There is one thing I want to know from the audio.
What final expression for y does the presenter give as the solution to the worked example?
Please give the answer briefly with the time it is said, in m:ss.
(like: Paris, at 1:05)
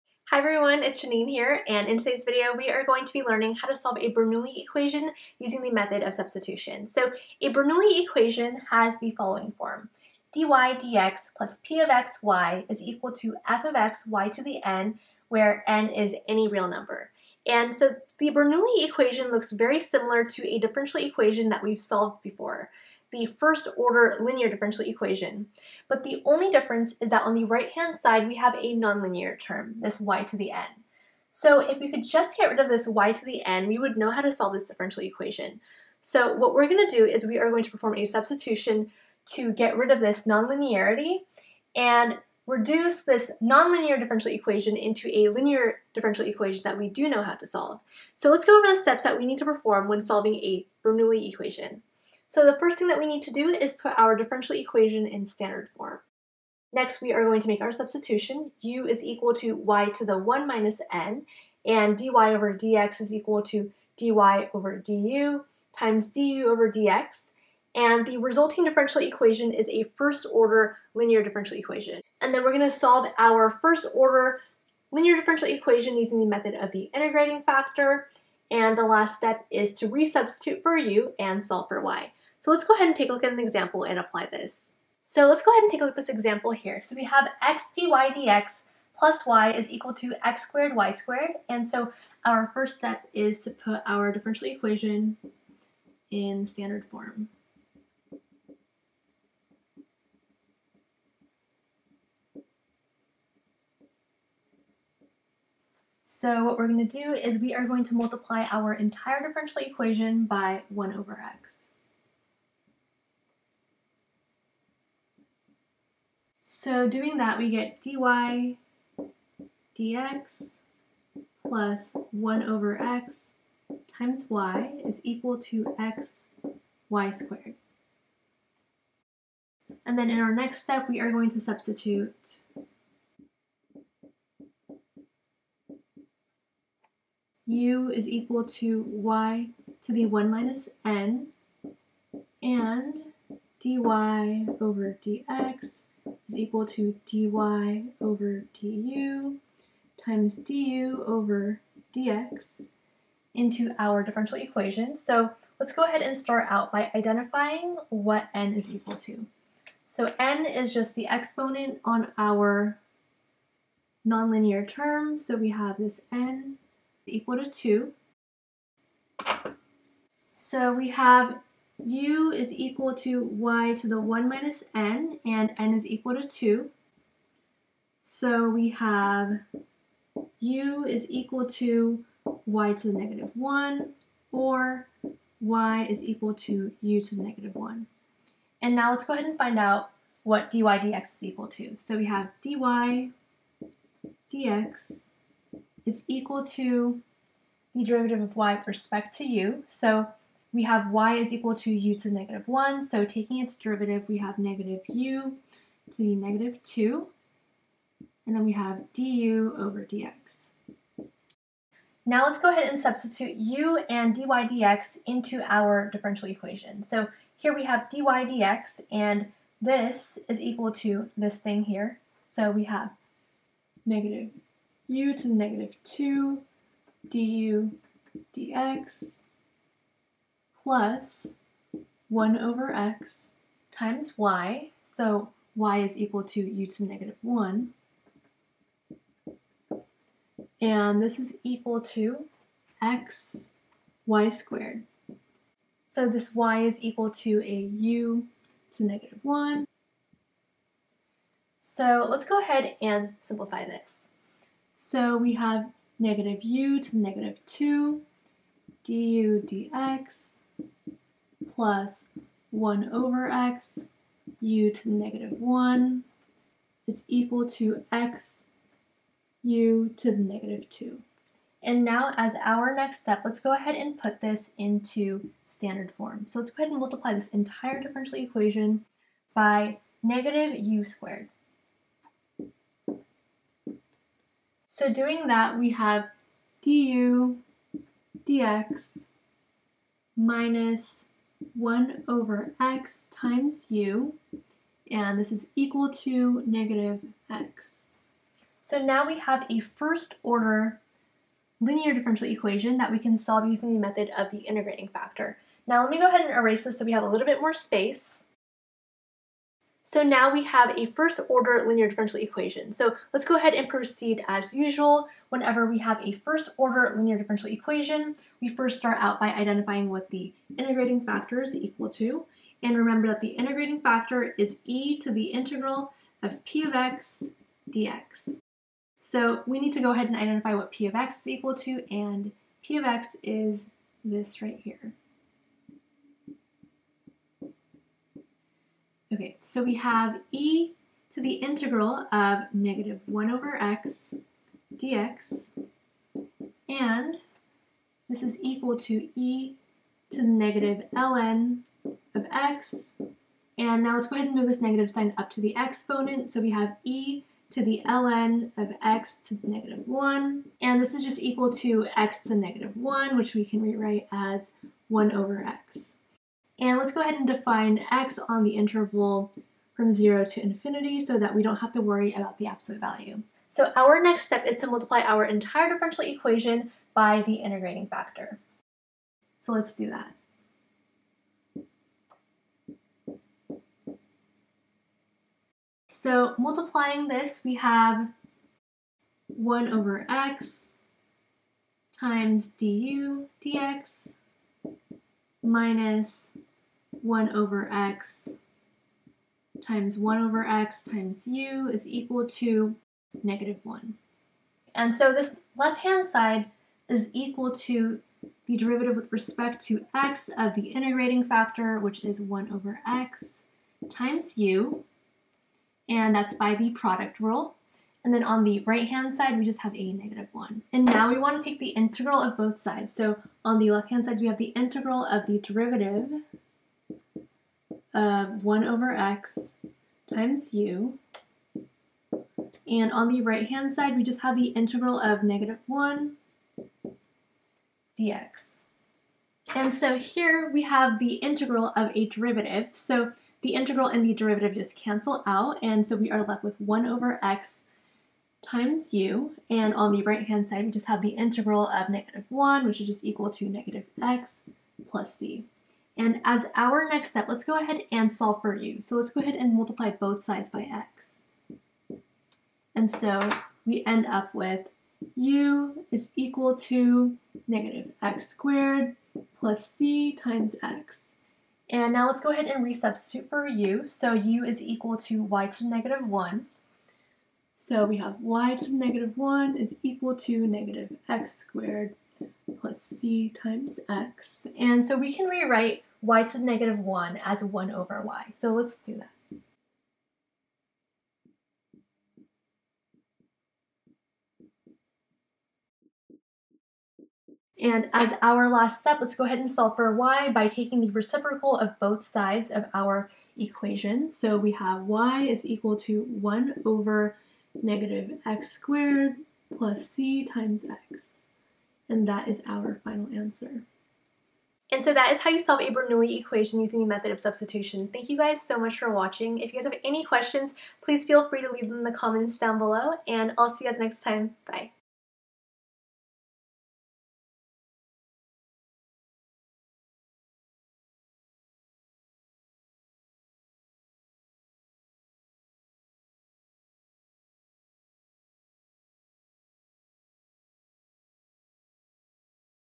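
1/(-x^2 + cx), at 8:26.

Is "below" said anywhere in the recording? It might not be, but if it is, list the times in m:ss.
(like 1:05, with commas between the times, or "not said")
8:42.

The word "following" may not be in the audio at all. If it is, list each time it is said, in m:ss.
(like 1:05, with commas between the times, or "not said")
0:09.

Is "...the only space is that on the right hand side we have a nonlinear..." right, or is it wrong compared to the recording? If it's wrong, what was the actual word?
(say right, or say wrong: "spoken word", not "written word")
wrong: "difference", not "space".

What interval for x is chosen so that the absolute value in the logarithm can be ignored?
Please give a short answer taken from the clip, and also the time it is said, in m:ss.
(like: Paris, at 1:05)
0 to infinity, at 6:09.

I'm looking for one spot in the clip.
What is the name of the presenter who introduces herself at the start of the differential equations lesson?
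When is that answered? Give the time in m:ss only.
0:01.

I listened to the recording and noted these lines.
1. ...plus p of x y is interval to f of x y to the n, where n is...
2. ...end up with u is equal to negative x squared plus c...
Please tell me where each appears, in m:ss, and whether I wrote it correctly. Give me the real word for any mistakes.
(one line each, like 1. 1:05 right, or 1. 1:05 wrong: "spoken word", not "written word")
1. 0:11 wrong: "equal", not "interval"
2. 7:43 right.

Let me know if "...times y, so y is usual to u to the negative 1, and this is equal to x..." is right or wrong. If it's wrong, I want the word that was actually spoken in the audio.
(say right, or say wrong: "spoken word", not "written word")
wrong: "equal", not "usual".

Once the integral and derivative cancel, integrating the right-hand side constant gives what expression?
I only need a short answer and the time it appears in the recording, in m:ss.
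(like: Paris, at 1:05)
negative x plus c, at 7:33.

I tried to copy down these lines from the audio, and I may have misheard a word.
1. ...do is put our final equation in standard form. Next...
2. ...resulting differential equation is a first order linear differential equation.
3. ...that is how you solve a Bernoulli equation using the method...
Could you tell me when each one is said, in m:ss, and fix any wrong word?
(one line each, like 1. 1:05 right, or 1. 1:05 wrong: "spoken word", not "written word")
1. 0:53 wrong: "differential", not "final"
2. 1:08 right
3. 8:34 right.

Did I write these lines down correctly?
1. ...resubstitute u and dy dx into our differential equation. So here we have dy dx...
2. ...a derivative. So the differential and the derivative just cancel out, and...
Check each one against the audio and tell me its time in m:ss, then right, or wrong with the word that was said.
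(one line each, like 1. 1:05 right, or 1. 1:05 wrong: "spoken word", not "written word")
1. 3:32 wrong: "substitute", not "resubstitute"
2. 7:21 wrong: "integral", not "differential".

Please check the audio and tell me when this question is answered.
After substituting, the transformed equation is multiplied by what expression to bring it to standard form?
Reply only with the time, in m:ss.
4:40.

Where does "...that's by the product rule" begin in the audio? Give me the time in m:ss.
6:56.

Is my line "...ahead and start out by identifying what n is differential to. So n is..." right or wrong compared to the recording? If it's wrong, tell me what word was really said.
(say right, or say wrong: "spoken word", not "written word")
wrong: "equal", not "differential".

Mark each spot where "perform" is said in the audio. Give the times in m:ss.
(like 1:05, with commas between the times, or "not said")
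0:37, 0:49.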